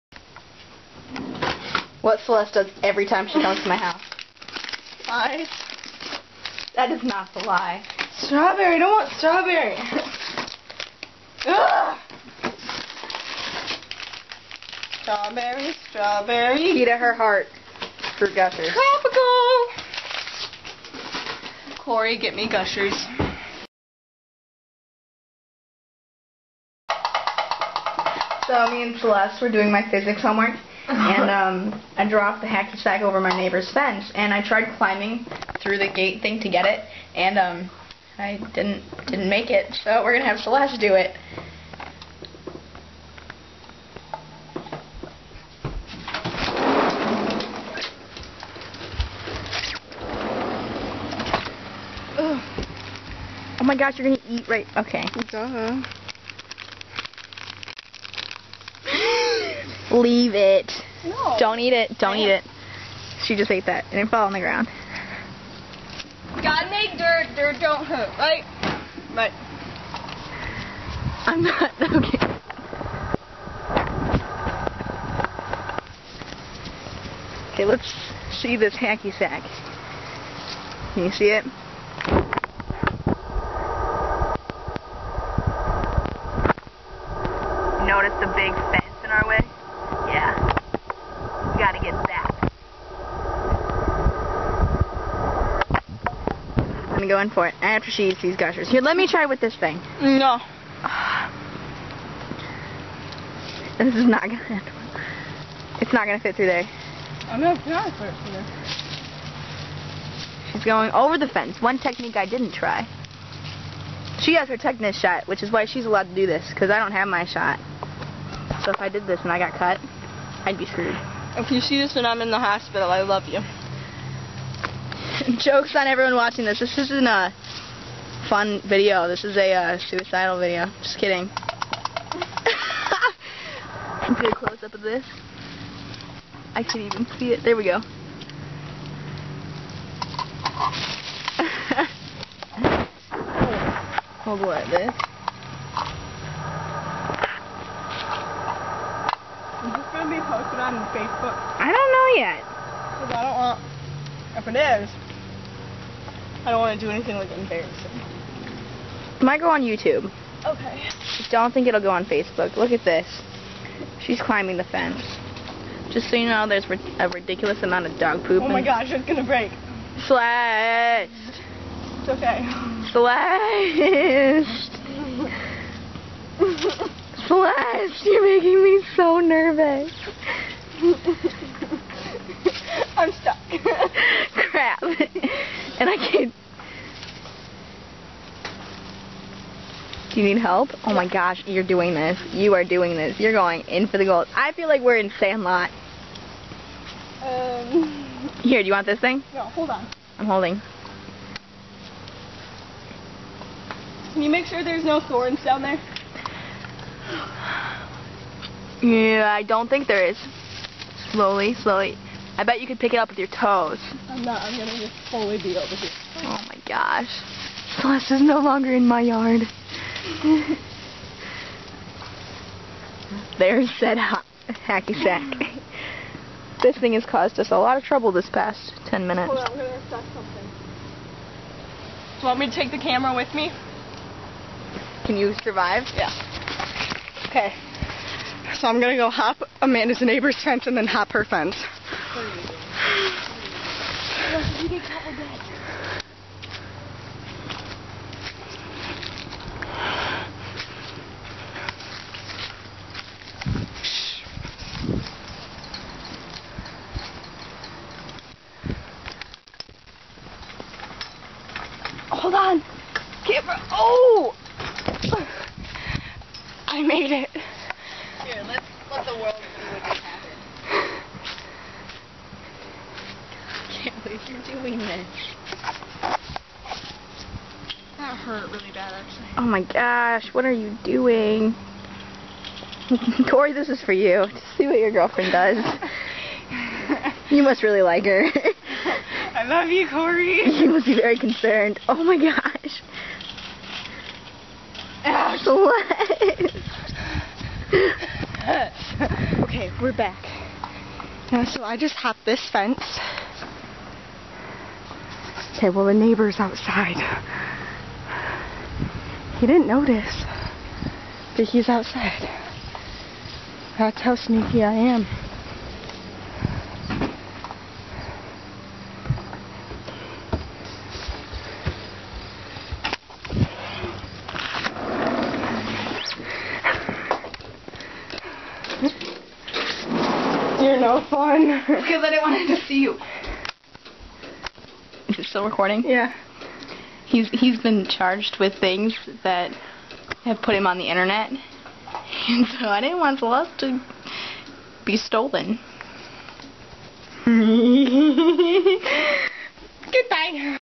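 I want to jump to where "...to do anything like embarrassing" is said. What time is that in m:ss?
2:36.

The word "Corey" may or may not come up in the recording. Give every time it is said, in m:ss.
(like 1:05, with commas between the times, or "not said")
0:21, 4:43, 4:49.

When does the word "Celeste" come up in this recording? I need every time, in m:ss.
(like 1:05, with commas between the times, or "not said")
0:02, 0:28, 0:40, 3:37, 5:43.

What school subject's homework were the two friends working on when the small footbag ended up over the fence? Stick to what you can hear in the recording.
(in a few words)
Physics.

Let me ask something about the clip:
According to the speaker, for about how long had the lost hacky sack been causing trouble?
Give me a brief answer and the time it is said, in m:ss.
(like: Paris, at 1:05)
10 minutes, at 3:48.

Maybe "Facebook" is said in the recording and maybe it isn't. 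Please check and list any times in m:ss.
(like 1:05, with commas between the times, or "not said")
2:30, 2:42.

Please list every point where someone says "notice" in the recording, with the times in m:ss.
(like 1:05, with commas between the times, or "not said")
1:27, 5:09.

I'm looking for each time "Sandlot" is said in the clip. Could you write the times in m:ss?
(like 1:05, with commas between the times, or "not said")
3:15.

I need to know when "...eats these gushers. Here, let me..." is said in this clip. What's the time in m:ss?
1:38.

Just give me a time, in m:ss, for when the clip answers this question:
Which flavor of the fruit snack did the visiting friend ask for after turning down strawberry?
0:18.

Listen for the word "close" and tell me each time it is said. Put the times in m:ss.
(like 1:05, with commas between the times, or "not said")
2:14.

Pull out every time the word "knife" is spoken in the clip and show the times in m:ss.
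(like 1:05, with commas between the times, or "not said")
not said.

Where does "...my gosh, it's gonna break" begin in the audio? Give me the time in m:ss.
2:48.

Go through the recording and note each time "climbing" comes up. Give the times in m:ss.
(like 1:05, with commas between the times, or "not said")
0:34, 2:44.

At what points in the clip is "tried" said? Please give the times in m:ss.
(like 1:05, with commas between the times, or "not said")
0:34.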